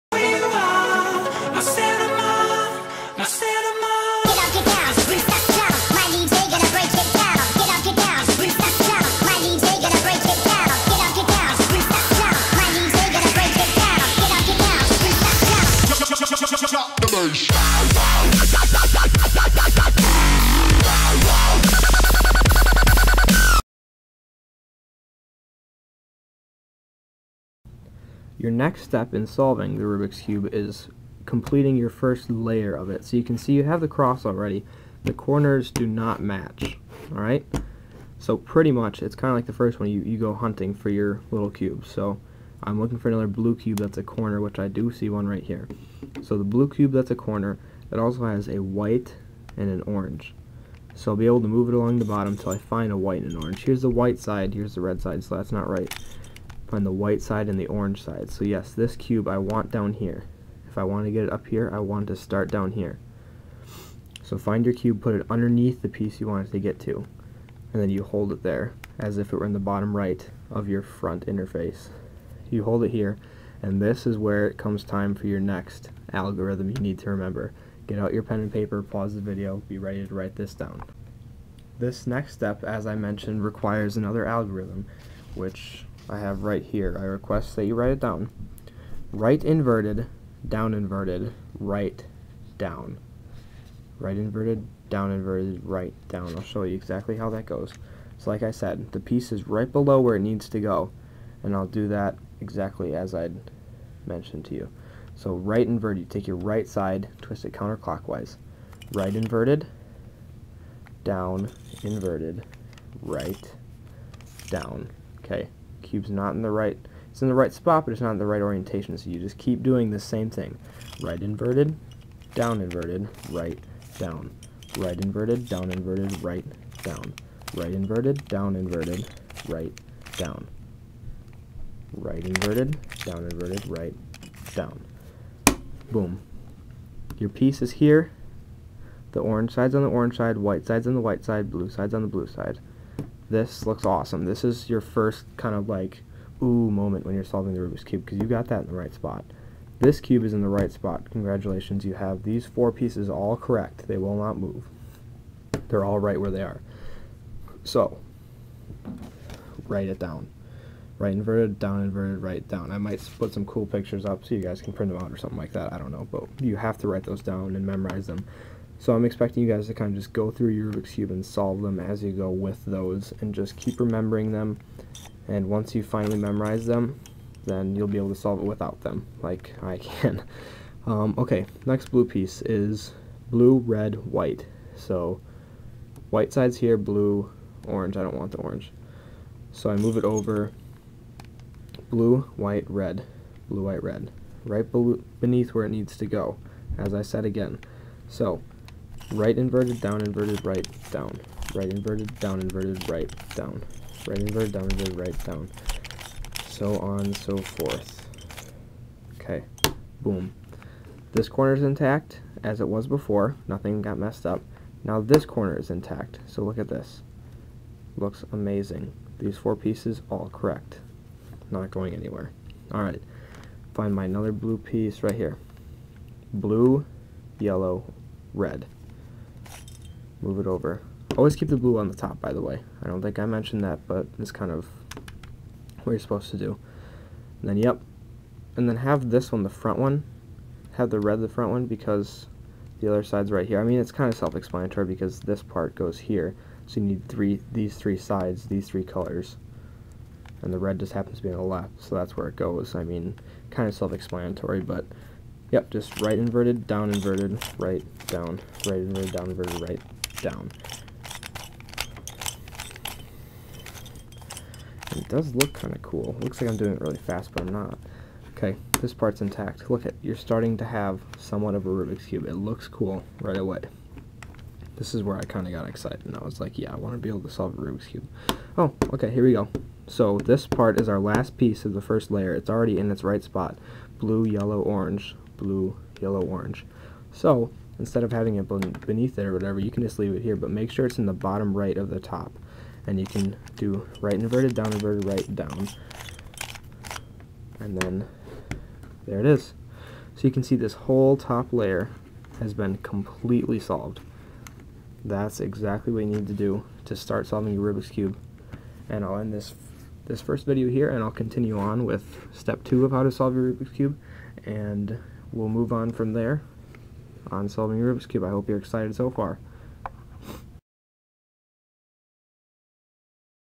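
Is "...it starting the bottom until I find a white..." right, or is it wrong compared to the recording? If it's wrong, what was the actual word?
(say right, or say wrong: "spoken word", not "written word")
wrong: "along", not "starting".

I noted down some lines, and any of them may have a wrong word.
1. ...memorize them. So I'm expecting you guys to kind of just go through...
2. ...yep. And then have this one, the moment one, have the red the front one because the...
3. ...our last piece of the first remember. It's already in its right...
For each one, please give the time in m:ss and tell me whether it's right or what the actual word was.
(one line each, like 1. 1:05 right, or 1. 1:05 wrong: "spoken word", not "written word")
1. 2:47 right
2. 3:57 wrong: "front", not "moment"
3. 4:40 wrong: "layer", not "remember".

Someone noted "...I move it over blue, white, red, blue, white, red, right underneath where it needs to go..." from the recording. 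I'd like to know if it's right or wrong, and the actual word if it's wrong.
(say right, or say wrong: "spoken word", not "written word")
wrong: "beneath", not "underneath".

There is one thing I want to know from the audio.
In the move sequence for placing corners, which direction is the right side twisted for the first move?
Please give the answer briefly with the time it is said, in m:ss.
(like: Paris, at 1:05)
counterclockwise, at 1:47.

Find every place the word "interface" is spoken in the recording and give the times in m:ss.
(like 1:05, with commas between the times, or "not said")
1:11.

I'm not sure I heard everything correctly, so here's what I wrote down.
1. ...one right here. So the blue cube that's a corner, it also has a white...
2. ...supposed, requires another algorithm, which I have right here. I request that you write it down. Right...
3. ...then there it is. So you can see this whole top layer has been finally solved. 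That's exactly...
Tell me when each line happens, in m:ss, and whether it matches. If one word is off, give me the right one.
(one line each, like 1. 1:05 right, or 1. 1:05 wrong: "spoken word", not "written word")
1. 0:45 right
2. 1:22 wrong: "mentioned", not "supposed"
3. 4:57 wrong: "completely", not "finally".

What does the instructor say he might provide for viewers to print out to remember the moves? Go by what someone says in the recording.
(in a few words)
pictures.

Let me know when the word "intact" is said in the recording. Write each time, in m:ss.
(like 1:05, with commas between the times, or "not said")
3:31, 3:35, 4:29.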